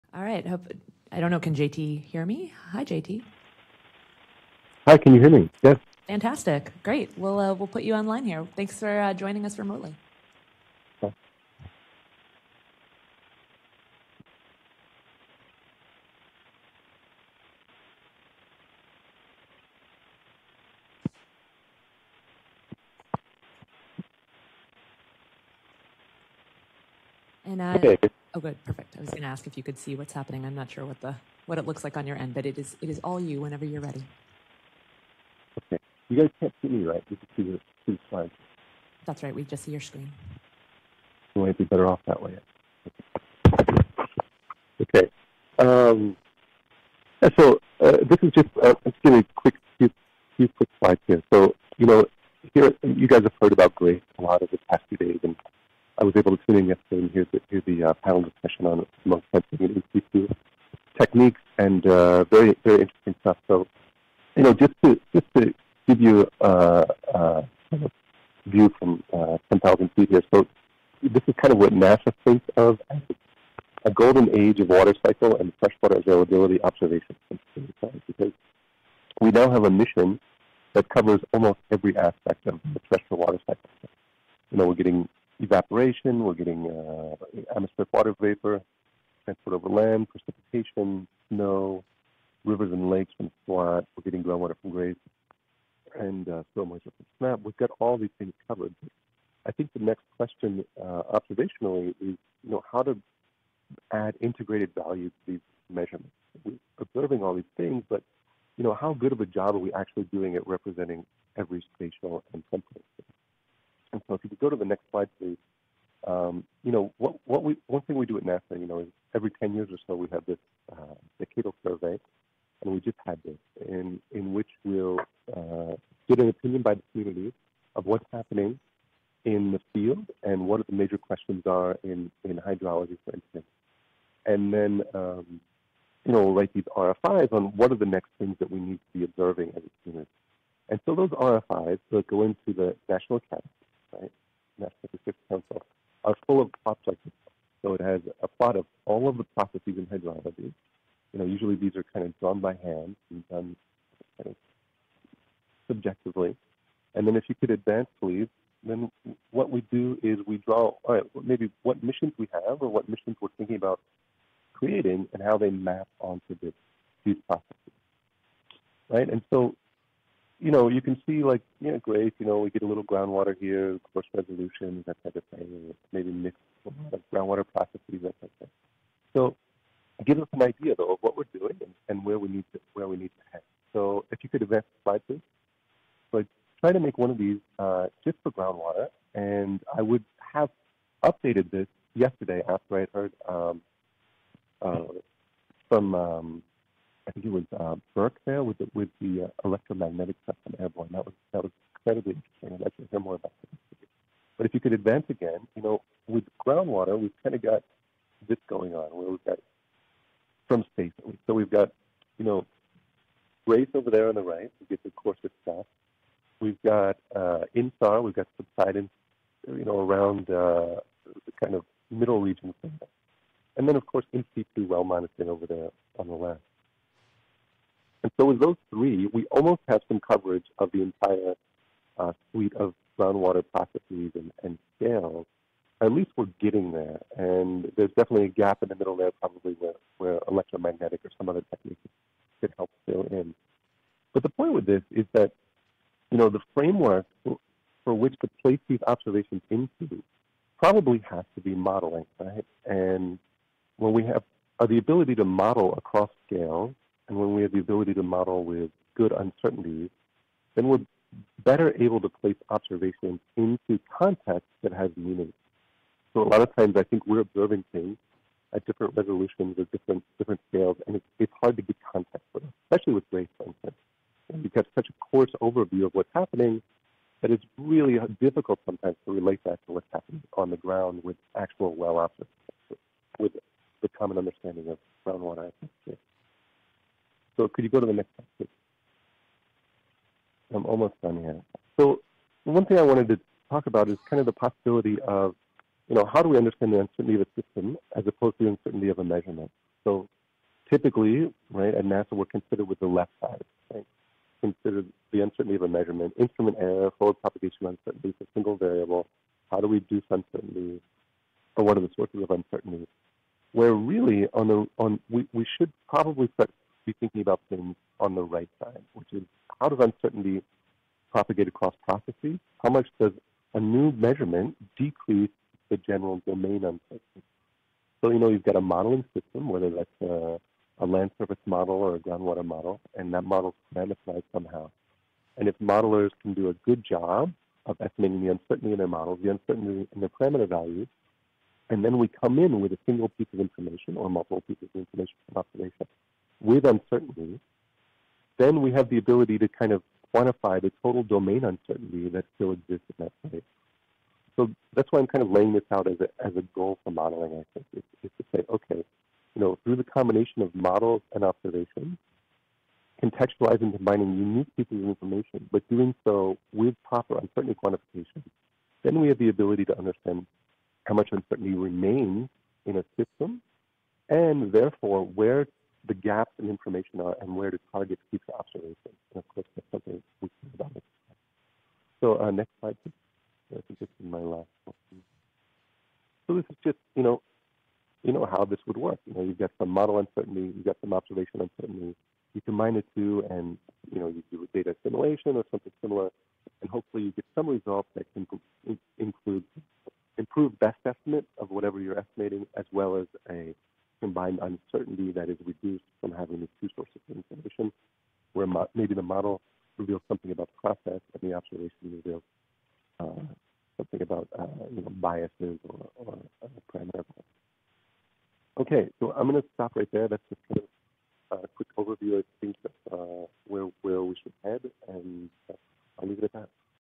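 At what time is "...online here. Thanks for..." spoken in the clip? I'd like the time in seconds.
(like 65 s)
7 s.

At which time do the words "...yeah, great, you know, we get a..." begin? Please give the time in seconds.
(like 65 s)
171 s.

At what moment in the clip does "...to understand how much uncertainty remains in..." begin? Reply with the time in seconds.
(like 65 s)
369 s.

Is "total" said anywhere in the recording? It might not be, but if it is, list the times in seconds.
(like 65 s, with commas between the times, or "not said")
350 s.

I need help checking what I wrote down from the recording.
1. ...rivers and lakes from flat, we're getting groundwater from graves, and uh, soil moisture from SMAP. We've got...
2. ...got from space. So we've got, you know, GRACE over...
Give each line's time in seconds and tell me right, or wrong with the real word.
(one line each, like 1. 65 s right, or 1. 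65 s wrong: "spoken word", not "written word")
1. 92 s right
2. 209 s right.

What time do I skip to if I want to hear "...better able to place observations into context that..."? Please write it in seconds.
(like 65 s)
261 s.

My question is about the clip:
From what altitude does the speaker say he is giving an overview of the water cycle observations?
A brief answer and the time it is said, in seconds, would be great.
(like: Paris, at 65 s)
10,000 feet, at 69 s.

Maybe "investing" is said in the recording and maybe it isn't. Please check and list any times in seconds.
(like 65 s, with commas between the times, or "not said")
not said.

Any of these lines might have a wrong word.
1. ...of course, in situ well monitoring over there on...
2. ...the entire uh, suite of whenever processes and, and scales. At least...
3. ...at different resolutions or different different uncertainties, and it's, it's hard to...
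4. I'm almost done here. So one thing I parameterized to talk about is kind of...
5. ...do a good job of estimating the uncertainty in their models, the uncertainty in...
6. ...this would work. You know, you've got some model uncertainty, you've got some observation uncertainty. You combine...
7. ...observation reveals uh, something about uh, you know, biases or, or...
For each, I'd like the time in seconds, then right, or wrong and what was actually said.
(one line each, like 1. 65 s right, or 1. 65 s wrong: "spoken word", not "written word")
1. 223 s right
2. 230 s wrong: "groundwater", not "whenever"
3. 268 s wrong: "scales", not "uncertainties"
4. 290 s wrong: "wanted", not "parameterized"
5. 336 s right
6. 388 s right
7. 411 s right.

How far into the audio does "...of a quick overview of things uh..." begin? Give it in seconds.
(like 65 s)
421 s.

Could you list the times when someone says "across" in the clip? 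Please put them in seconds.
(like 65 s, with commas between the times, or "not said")
255 s, 321 s.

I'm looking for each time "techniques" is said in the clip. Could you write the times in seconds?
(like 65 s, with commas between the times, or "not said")
60 s, 241 s.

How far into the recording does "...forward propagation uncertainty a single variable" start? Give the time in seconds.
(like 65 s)
306 s.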